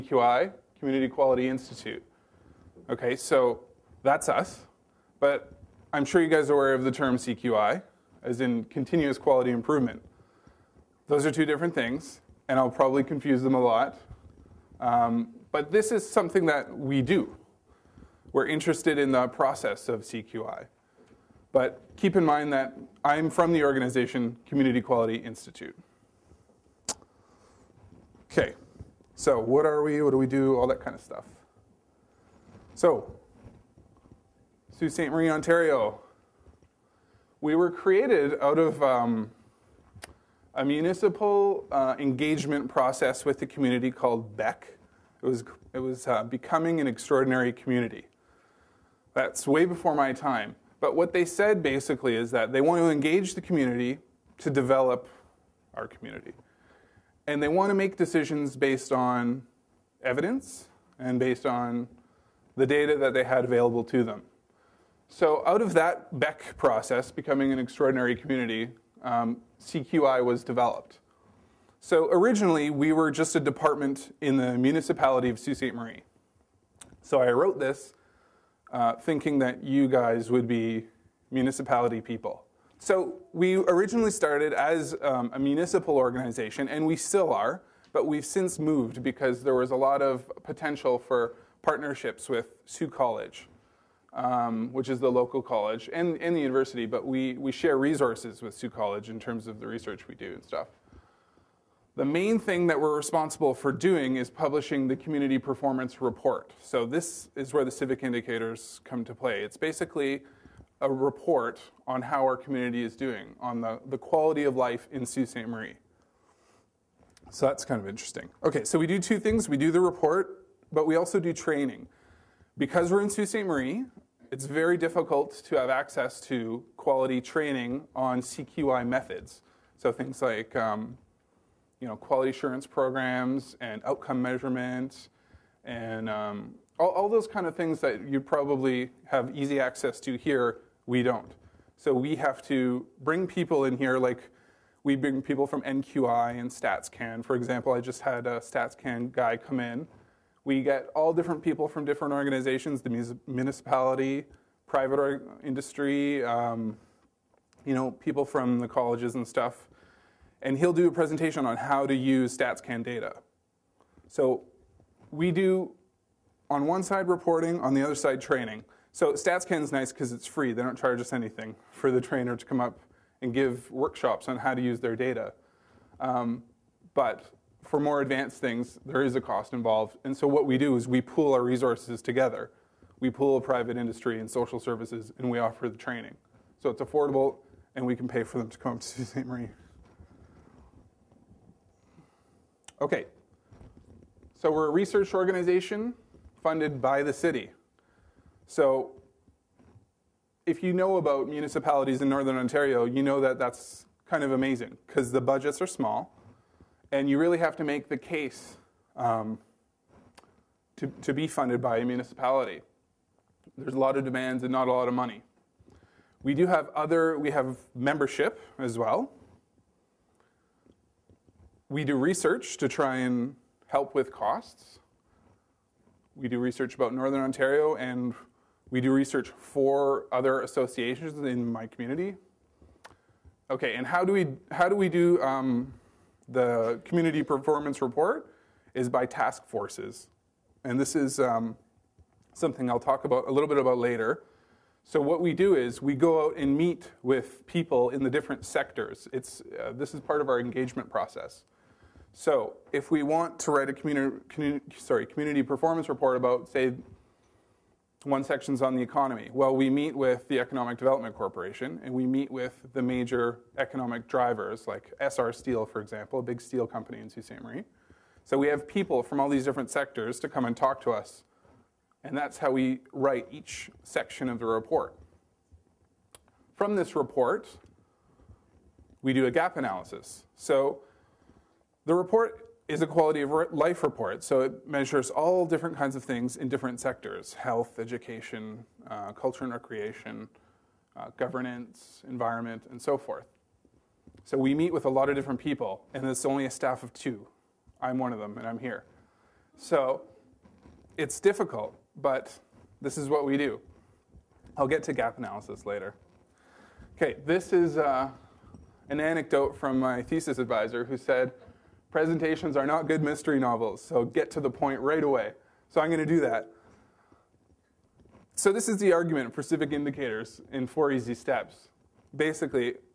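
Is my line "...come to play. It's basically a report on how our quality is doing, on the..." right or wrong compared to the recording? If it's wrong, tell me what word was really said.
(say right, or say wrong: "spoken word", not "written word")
wrong: "community", not "quality".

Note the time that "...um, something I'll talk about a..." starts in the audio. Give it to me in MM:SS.
04:01.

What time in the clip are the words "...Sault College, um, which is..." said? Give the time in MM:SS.
01:32.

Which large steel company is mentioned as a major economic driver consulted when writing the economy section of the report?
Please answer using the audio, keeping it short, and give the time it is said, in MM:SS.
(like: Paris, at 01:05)
Essar Steel, at 04:25.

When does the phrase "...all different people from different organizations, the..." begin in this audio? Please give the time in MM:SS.
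02:30.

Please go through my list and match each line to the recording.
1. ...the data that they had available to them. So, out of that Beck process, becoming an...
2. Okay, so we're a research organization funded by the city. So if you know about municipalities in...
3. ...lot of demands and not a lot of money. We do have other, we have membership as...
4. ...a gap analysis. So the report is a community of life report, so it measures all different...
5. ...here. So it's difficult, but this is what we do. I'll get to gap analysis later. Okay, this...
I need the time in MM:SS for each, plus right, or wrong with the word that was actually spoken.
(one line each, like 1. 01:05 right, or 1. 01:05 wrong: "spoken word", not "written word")
1. 01:02 right
2. 03:12 right
3. 03:33 right
4. 04:39 wrong: "quality", not "community"
5. 04:58 right.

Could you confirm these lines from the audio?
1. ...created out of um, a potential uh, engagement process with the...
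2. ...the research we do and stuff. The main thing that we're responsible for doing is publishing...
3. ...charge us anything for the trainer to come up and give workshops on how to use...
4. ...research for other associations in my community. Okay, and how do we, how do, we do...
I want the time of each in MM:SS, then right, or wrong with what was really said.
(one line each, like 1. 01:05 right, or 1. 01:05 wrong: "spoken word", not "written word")
1. 00:37 wrong: "municipal", not "potential"
2. 01:39 right
3. 02:50 right
4. 03:48 right.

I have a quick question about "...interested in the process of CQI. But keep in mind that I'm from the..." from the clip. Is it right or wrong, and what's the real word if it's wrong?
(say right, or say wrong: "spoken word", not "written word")
right.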